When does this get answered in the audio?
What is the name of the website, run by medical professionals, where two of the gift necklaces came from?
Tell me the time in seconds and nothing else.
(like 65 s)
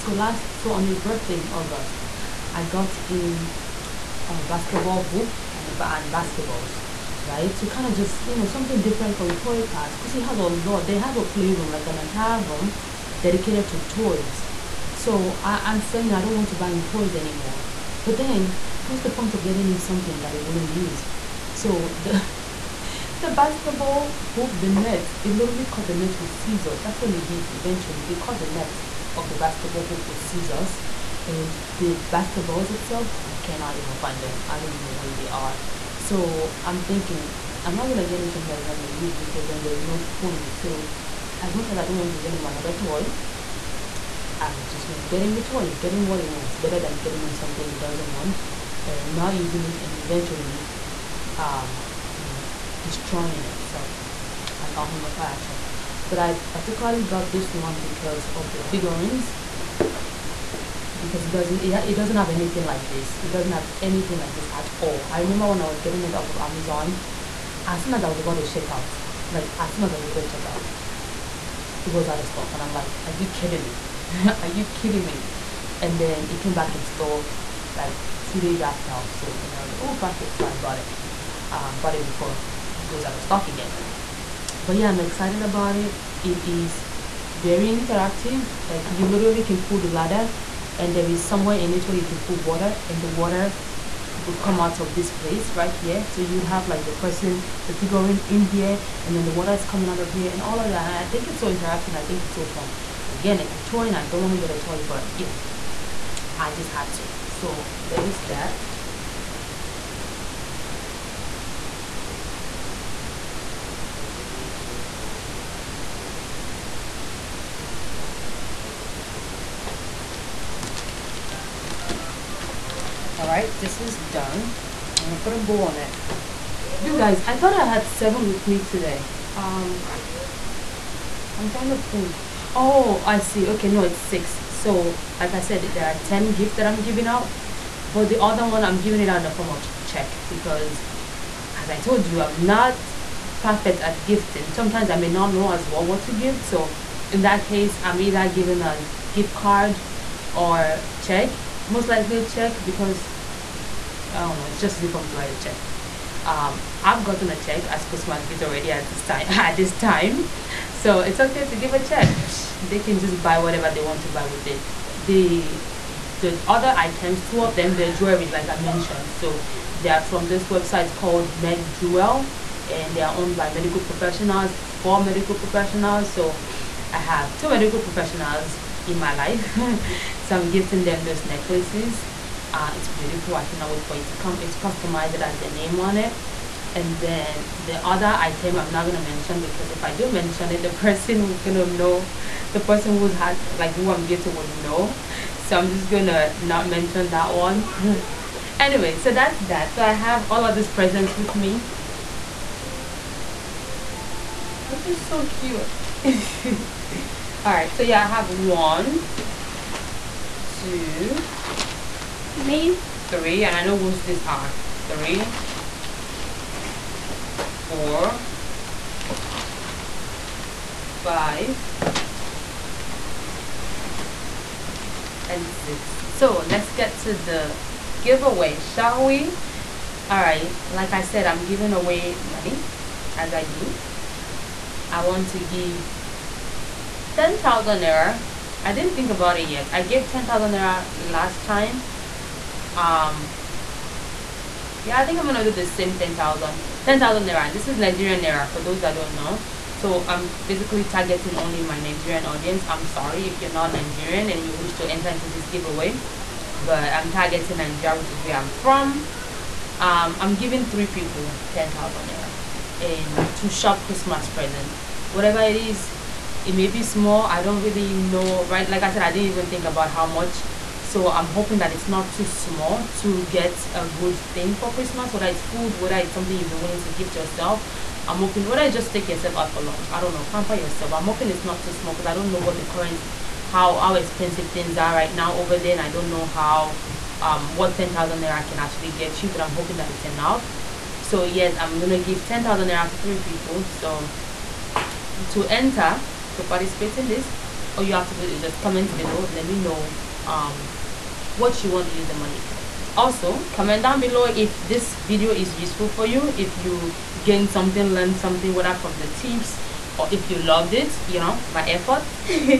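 171 s.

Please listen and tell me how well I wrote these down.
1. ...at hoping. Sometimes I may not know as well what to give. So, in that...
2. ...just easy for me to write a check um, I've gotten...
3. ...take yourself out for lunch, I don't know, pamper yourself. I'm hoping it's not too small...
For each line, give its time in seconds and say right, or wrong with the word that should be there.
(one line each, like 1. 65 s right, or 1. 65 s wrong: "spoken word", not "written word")
1. 143 s wrong: "gifting", not "hoping"
2. 154 s right
3. 278 s right.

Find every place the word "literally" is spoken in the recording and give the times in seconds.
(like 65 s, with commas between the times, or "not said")
25 s, 89 s.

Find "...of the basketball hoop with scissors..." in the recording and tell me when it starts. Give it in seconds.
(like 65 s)
29 s.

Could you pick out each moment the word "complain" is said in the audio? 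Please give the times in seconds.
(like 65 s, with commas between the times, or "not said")
not said.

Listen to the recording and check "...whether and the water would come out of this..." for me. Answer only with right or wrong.
wrong.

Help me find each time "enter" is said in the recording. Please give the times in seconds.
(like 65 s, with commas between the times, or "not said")
254 s, 295 s.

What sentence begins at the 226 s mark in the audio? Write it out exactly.
So let's get to the giveaway, shall we?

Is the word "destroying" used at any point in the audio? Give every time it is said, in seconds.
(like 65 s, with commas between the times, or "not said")
52 s.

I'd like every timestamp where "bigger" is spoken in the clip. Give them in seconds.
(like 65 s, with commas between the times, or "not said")
not said.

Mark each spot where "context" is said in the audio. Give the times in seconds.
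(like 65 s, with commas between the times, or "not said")
not said.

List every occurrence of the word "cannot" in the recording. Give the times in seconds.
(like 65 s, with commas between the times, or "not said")
33 s, 183 s.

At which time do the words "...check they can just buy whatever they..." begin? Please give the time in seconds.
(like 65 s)
161 s.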